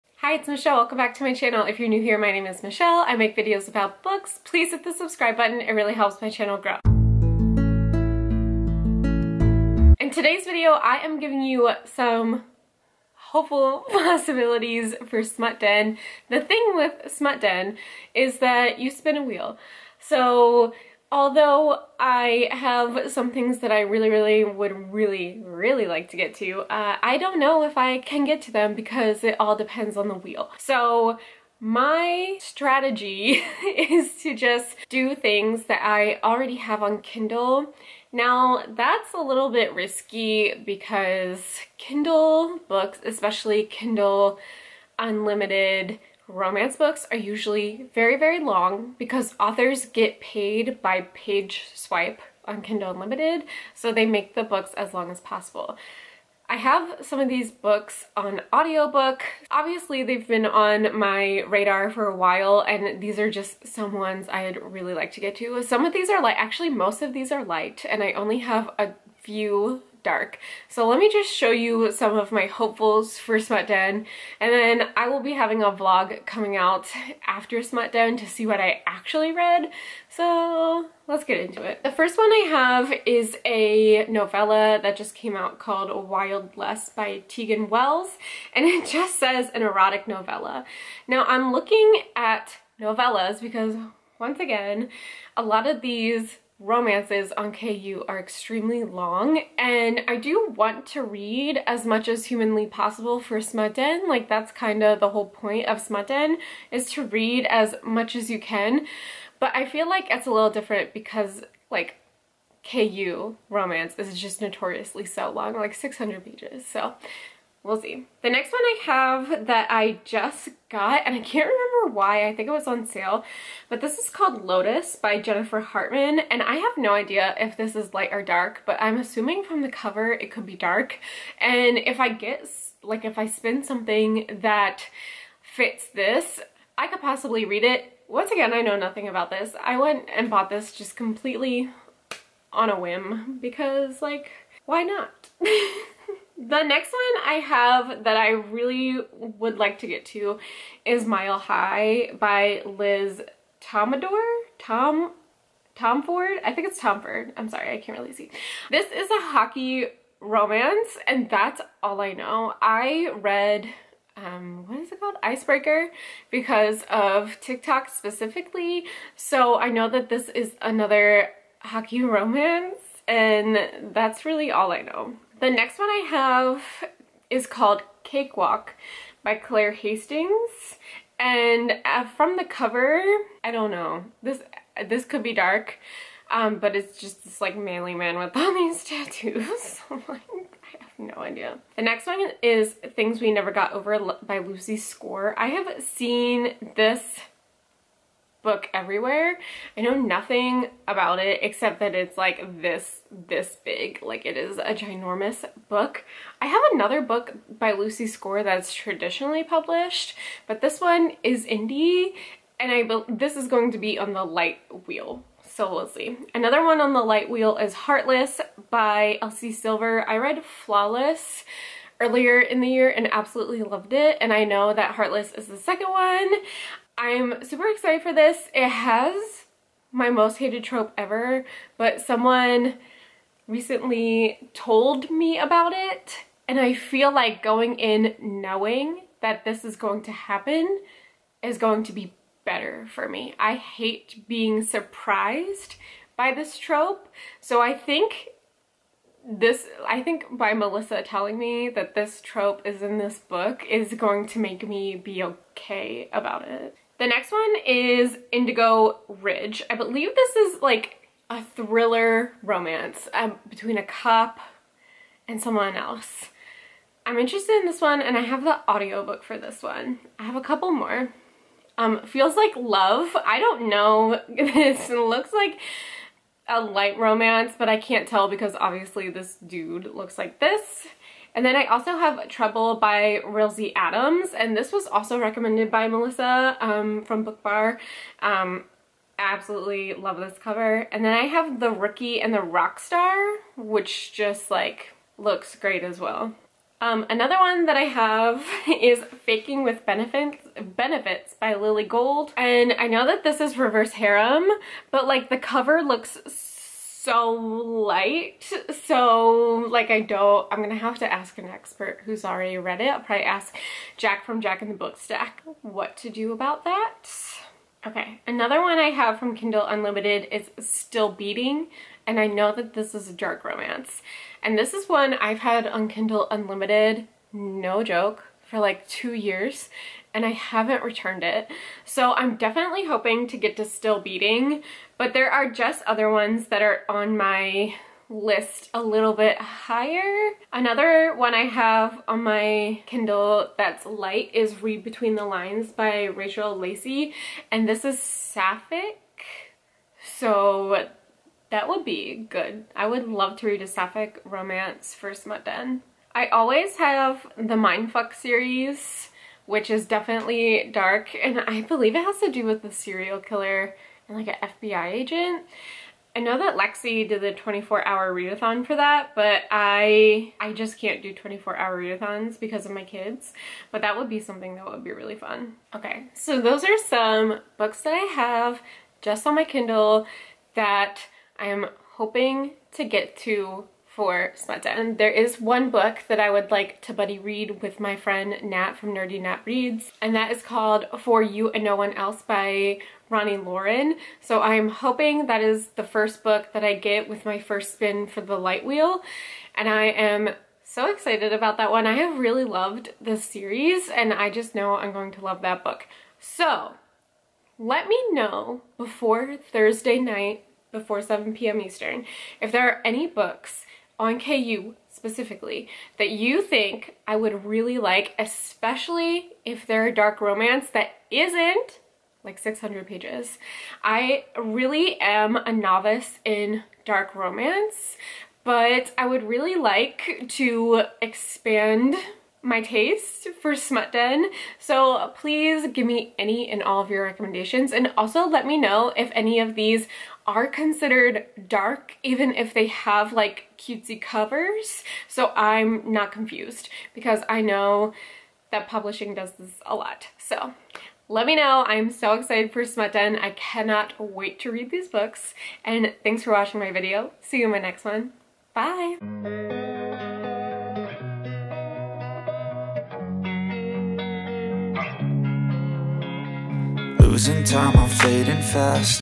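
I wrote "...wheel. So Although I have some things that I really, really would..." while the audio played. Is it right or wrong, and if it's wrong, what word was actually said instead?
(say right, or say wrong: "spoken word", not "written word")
right.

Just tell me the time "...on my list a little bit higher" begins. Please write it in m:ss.
5:36.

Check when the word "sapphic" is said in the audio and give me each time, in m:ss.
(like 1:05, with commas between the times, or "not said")
5:47, 5:53.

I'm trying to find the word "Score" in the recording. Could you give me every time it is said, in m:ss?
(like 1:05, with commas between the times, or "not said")
3:14, 3:28.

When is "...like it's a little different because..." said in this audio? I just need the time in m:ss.
1:49.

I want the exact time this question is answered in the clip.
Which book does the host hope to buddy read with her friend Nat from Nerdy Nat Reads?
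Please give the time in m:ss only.
6:30.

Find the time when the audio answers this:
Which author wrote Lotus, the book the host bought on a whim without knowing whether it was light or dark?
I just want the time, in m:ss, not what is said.
2:05.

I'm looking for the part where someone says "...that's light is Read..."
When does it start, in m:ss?
5:43.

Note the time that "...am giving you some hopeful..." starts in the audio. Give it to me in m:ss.
0:11.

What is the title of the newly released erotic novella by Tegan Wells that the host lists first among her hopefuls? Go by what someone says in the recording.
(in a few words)
Wild Less.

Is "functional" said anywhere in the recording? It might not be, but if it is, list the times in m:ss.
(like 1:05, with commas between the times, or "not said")
not said.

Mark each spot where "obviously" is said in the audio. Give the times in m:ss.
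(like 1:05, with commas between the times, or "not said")
0:59, 4:38.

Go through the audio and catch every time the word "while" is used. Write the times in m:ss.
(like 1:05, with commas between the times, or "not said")
1:02.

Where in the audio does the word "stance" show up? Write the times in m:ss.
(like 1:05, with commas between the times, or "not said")
not said.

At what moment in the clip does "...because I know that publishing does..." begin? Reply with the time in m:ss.
7:26.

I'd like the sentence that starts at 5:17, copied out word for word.
Okay, another one I have from Kindle Unlimited is Still Beating, and I know that this is a dark romance.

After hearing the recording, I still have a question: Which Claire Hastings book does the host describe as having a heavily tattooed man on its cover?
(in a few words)
Cakewalk.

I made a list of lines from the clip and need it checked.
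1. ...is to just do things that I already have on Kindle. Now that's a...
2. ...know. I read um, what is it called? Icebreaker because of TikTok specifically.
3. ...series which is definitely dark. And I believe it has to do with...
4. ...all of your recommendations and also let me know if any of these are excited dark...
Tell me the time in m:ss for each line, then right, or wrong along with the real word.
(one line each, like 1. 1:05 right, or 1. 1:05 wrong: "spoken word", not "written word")
1. 0:33 right
2. 2:42 right
3. 5:58 right
4. 7:16 wrong: "considered", not "excited".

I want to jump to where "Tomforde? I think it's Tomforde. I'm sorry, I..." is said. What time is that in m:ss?
2:35.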